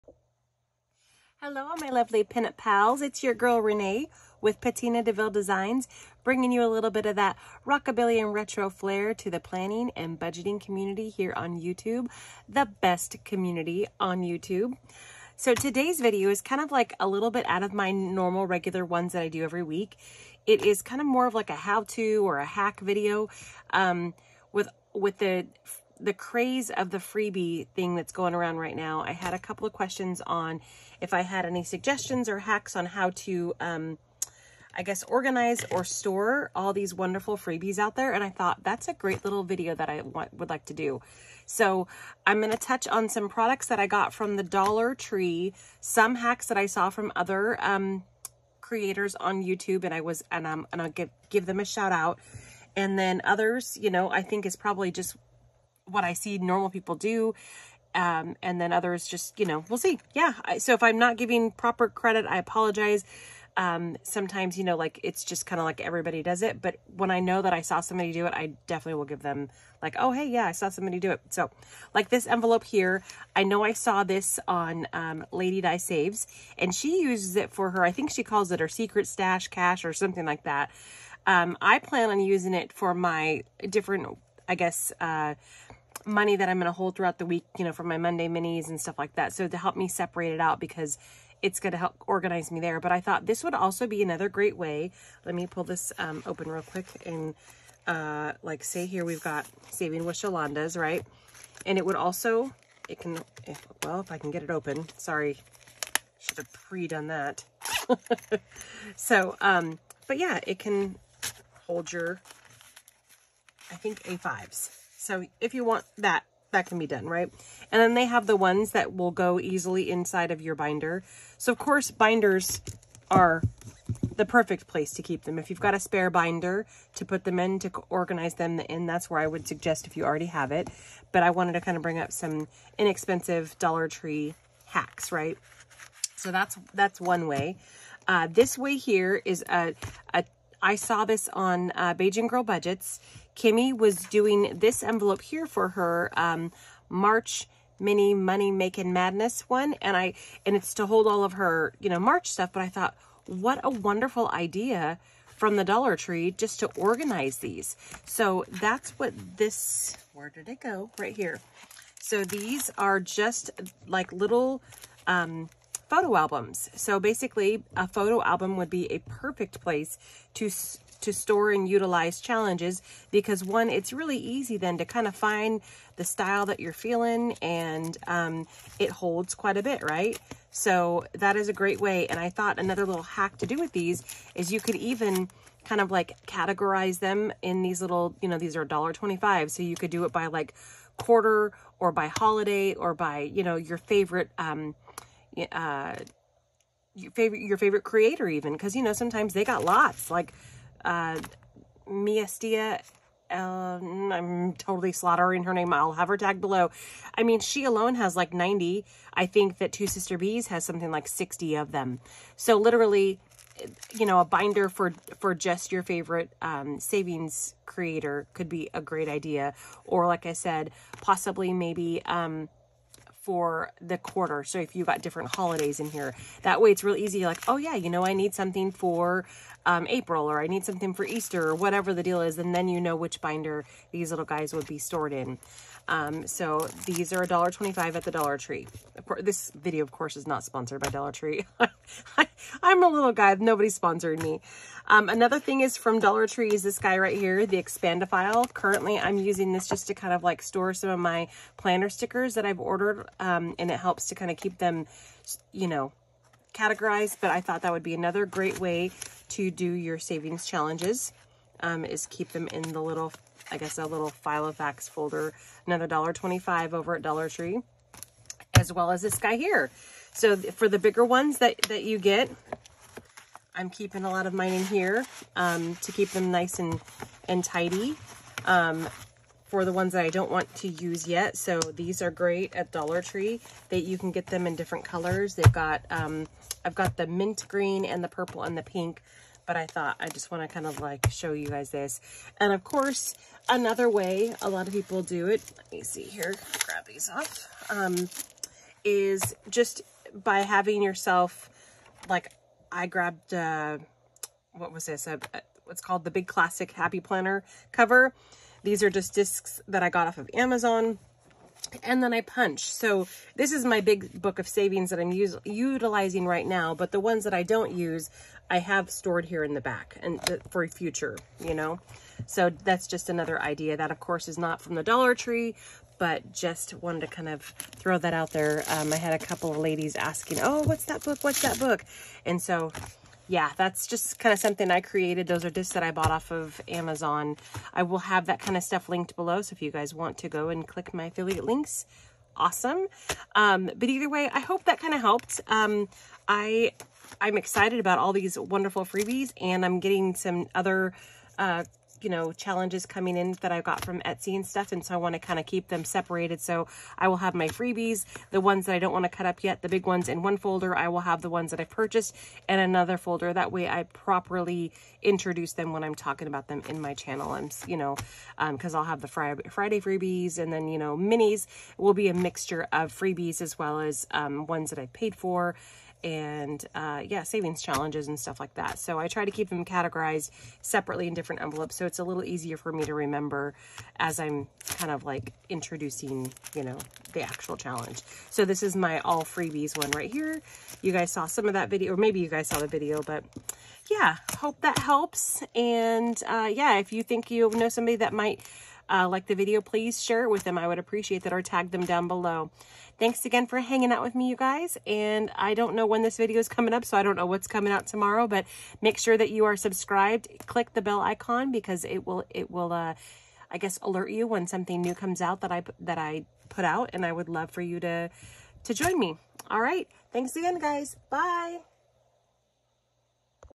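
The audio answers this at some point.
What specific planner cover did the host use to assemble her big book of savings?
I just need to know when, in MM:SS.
05:06.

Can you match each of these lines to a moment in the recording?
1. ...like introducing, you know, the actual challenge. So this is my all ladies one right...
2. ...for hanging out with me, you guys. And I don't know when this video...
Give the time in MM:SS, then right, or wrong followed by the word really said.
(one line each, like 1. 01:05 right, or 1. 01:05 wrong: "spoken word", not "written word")
1. 06:25 wrong: "freebies", not "ladies"
2. 06:43 right.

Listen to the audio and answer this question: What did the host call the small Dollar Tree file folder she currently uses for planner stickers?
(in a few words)
Expandophile.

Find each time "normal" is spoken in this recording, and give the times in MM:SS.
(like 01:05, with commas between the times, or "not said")
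00:17, 00:56.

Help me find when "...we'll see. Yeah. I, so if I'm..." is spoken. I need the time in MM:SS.
00:59.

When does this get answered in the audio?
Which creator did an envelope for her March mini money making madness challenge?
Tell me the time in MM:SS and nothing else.
02:21.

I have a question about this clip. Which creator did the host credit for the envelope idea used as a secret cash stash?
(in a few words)
Lady Die Saves.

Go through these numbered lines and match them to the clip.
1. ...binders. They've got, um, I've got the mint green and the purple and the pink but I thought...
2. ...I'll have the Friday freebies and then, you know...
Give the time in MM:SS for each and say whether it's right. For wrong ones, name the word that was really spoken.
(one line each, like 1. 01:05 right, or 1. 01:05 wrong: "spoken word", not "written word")
1. 04:44 wrong: "colors", not "binders"
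2. 06:08 right.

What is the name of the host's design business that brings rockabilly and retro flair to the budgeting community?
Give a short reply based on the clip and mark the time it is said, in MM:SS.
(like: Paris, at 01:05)
Patina DeVille Designs, at 00:04.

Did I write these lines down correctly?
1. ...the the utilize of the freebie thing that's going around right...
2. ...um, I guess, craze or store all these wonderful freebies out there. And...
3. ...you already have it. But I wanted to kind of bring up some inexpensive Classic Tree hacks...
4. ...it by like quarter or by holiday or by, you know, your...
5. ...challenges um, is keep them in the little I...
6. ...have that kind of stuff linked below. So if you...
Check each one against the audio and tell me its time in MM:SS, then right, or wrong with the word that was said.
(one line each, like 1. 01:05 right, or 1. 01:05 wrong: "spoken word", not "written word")
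1. 00:25 wrong: "craze", not "utilize"
2. 00:33 wrong: "organize", not "craze"
3. 02:09 wrong: "Dollar", not "Classic"
4. 03:10 right
5. 04:20 right
6. 05:37 right.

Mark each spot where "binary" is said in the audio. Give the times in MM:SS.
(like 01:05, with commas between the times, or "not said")
not said.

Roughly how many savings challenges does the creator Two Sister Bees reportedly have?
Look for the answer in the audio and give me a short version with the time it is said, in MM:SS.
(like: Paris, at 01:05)
60, at 03:31.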